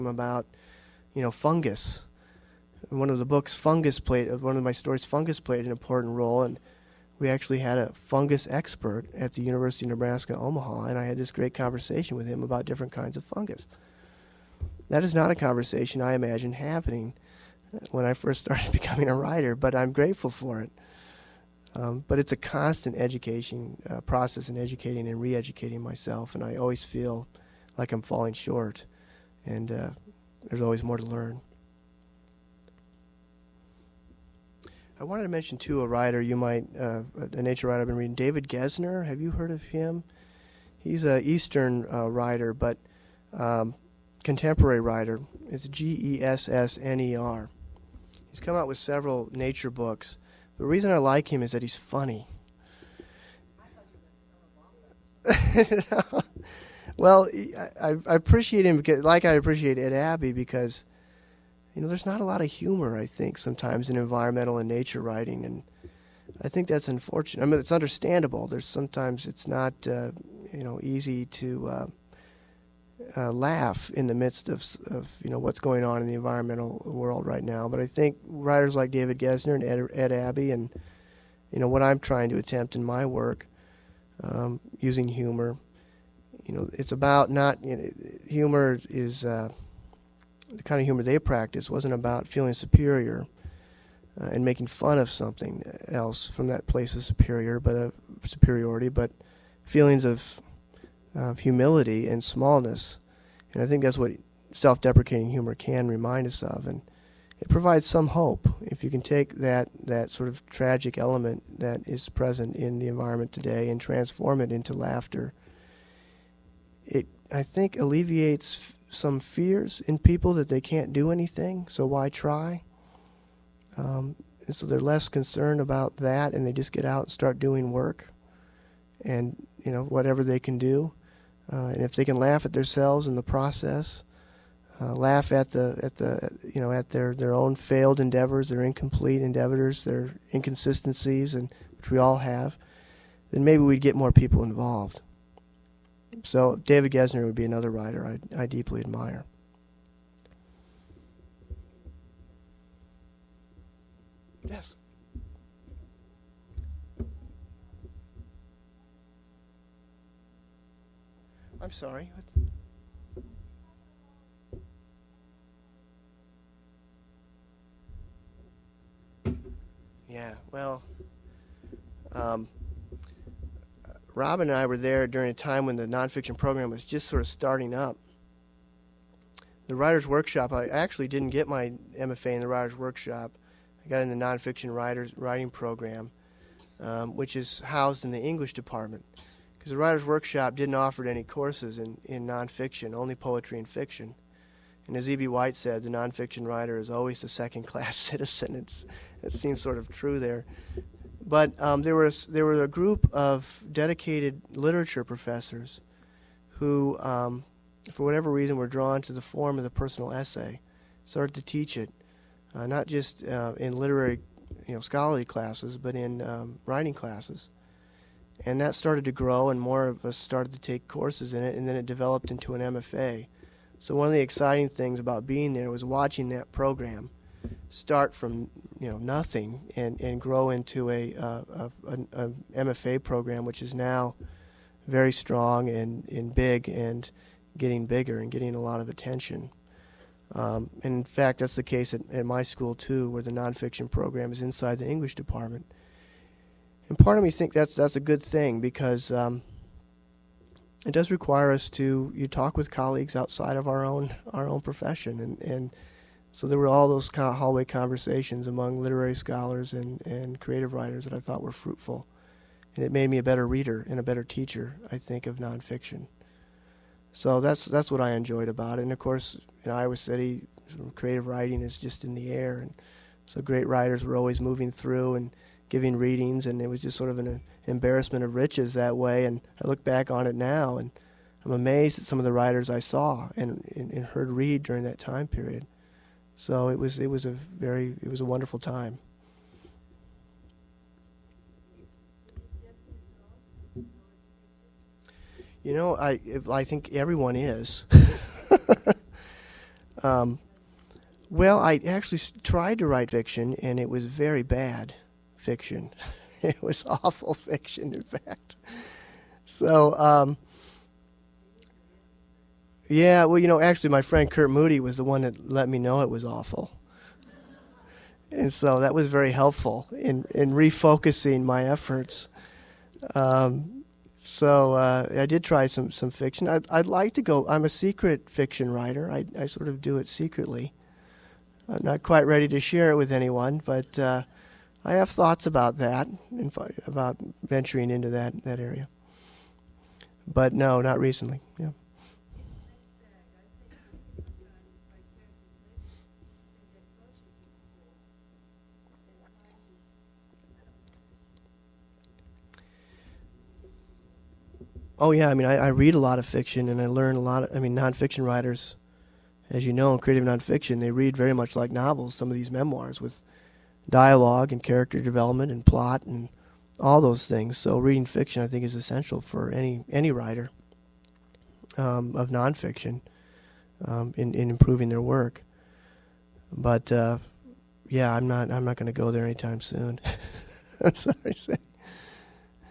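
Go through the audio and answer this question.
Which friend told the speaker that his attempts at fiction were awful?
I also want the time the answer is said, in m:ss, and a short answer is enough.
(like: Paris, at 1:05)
Kurt Moody, at 5:14.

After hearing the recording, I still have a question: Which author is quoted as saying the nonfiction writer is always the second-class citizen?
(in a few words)
E.B. White.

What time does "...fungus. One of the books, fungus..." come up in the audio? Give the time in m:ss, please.
0:01.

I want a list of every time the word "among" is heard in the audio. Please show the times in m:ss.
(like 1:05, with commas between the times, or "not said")
4:18.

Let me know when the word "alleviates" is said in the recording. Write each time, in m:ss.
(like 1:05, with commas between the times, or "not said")
1:57.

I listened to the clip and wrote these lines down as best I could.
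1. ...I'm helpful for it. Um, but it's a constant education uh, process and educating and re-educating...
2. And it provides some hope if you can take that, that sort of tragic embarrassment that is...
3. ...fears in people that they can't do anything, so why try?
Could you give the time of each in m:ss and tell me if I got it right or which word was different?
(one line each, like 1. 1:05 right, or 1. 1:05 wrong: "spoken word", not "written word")
1. 0:19 wrong: "grateful", not "helpful"
2. 1:46 wrong: "element", not "embarrassment"
3. 1:59 right.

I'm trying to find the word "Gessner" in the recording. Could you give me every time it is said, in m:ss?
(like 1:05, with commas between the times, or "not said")
0:38, 1:19, 2:26.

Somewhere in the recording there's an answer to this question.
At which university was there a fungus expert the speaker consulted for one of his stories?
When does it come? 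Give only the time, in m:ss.
0:09.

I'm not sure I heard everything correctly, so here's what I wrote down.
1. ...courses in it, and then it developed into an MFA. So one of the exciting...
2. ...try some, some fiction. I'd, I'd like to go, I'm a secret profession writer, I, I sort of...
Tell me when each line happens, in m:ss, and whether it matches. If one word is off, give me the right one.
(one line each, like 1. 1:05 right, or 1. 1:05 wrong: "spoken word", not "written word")
1. 3:40 right
2. 5:25 wrong: "fiction", not "profession".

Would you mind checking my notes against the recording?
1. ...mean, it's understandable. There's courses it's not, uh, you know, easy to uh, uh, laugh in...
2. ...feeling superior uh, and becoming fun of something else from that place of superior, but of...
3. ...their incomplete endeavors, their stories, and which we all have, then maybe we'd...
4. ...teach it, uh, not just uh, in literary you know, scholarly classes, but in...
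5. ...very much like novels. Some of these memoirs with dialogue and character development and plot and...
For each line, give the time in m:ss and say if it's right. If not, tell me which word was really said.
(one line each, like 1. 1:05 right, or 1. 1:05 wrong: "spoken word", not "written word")
1. 1:07 wrong: "sometimes", not "courses"
2. 1:32 wrong: "making", not "becoming"
3. 2:18 wrong: "inconsistencies", not "stories"
4. 3:31 right
5. 6:01 right.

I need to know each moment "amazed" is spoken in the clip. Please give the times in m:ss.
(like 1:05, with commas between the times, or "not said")
4:41.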